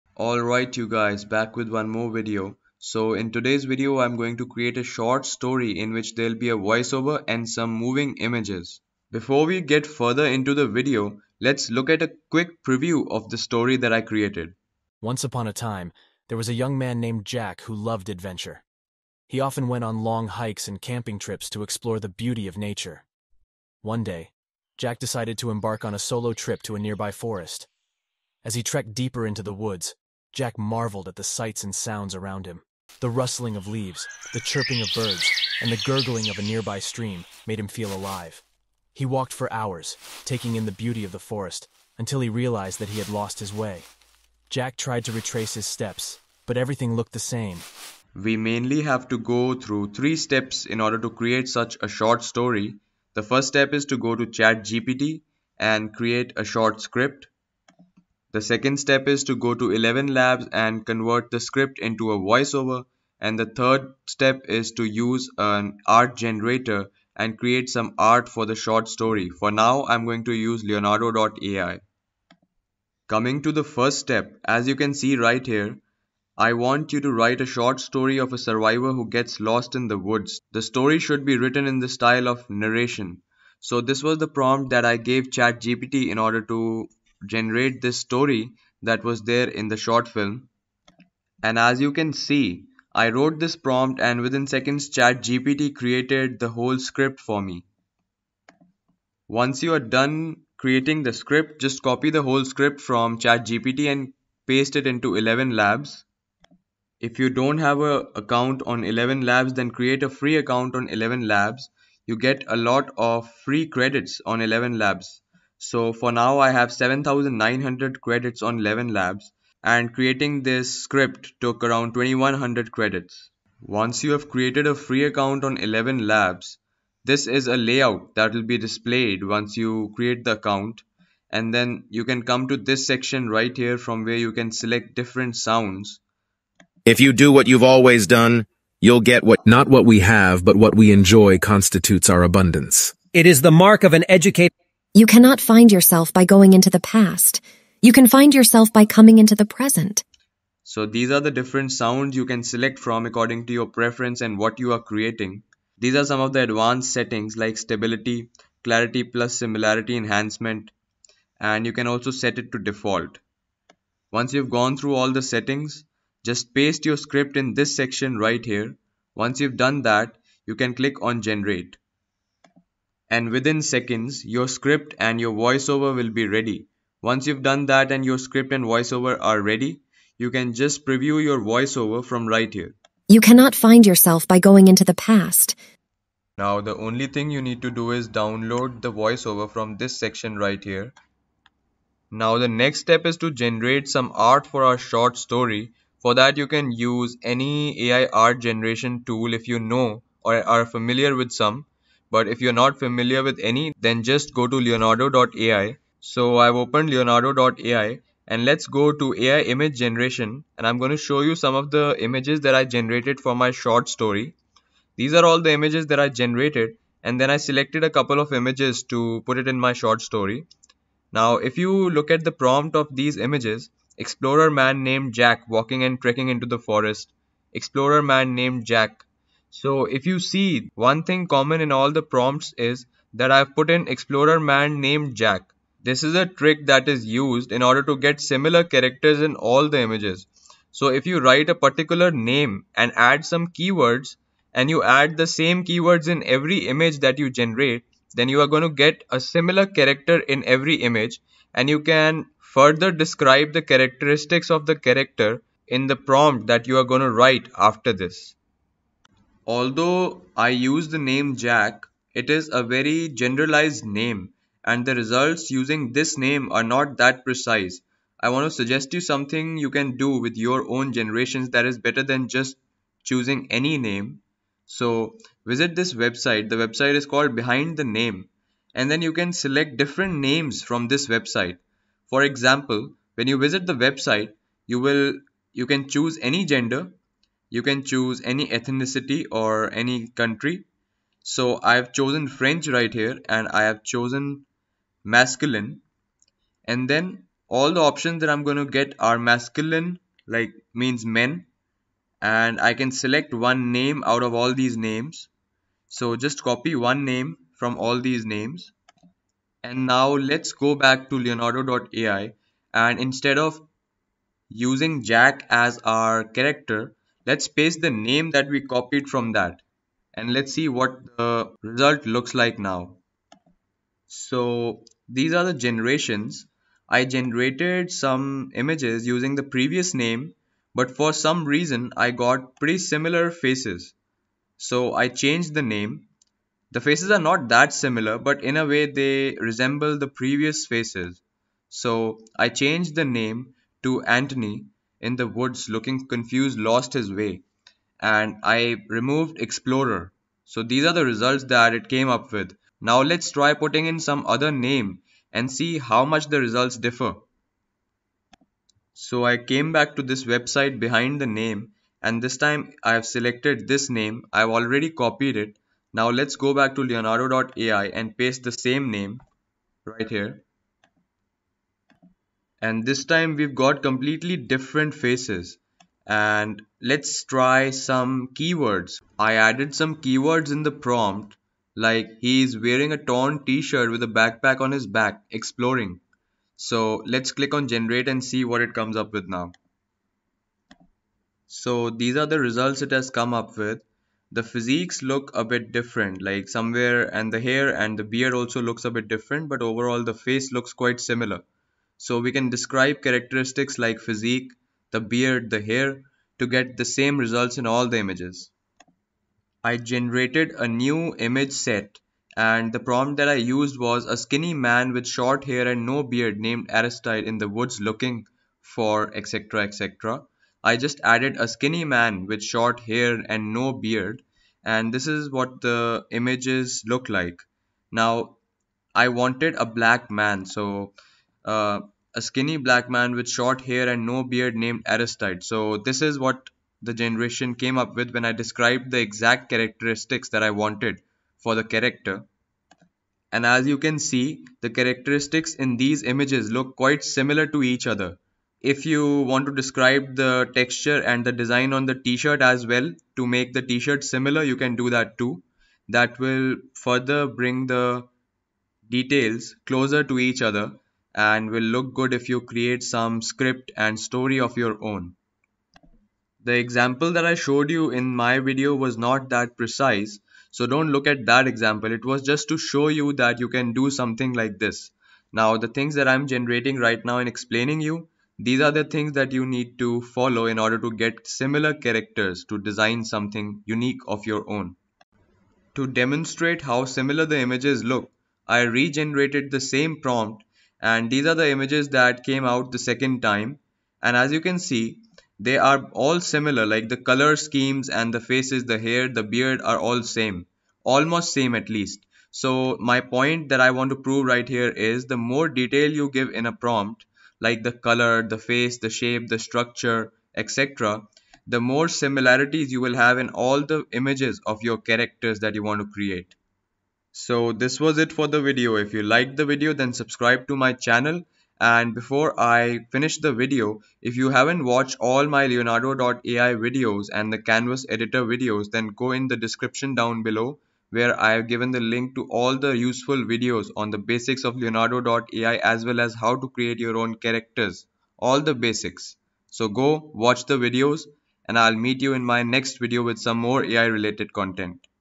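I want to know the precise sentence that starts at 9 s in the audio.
Before we get further into the video, let's look at a quick preview of the story that I created.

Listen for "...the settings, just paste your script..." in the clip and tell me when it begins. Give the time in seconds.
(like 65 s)
165 s.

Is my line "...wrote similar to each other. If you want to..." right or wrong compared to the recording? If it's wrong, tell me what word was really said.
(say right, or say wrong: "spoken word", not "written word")
wrong: "quite", not "wrote".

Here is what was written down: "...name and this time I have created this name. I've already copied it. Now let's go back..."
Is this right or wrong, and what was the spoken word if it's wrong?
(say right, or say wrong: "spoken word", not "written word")
wrong: "selected", not "created".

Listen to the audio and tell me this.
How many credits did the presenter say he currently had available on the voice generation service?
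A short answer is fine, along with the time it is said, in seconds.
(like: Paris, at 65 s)
7,900, at 116 s.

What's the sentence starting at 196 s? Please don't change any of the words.
For that you can use any AI art generation tool if you know or are familiar with some.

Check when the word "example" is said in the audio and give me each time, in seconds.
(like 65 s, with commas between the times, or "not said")
282 s, 466 s, 471 s.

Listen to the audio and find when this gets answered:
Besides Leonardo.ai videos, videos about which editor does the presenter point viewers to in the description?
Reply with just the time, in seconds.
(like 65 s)
527 s.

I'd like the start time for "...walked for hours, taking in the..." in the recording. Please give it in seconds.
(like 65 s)
39 s.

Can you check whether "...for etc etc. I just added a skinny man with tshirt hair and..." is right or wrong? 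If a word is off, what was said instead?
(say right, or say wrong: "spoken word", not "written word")
wrong: "short", not "tshirt".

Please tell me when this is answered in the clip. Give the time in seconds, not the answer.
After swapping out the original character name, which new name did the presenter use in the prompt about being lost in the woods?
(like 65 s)
344 s.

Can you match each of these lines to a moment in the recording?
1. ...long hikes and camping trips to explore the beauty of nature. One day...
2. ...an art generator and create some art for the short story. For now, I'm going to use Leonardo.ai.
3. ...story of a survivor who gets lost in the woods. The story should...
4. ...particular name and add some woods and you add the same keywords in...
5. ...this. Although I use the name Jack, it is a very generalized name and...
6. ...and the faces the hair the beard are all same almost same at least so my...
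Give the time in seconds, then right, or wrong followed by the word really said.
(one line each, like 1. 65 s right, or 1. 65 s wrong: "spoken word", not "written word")
1. 20 s right
2. 65 s right
3. 77 s right
4. 241 s wrong: "keywords", not "woods"
5. 257 s right
6. 497 s right.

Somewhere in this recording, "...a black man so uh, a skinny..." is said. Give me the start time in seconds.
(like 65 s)
429 s.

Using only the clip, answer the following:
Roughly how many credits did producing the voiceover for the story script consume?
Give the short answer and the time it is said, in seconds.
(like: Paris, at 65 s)
2100, at 121 s.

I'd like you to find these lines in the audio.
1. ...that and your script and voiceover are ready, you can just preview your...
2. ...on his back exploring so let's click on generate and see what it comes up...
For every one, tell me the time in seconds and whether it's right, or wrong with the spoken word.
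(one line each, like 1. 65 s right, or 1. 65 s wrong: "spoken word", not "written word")
1. 177 s right
2. 384 s right.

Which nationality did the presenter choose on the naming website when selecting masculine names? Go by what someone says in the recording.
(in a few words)
French.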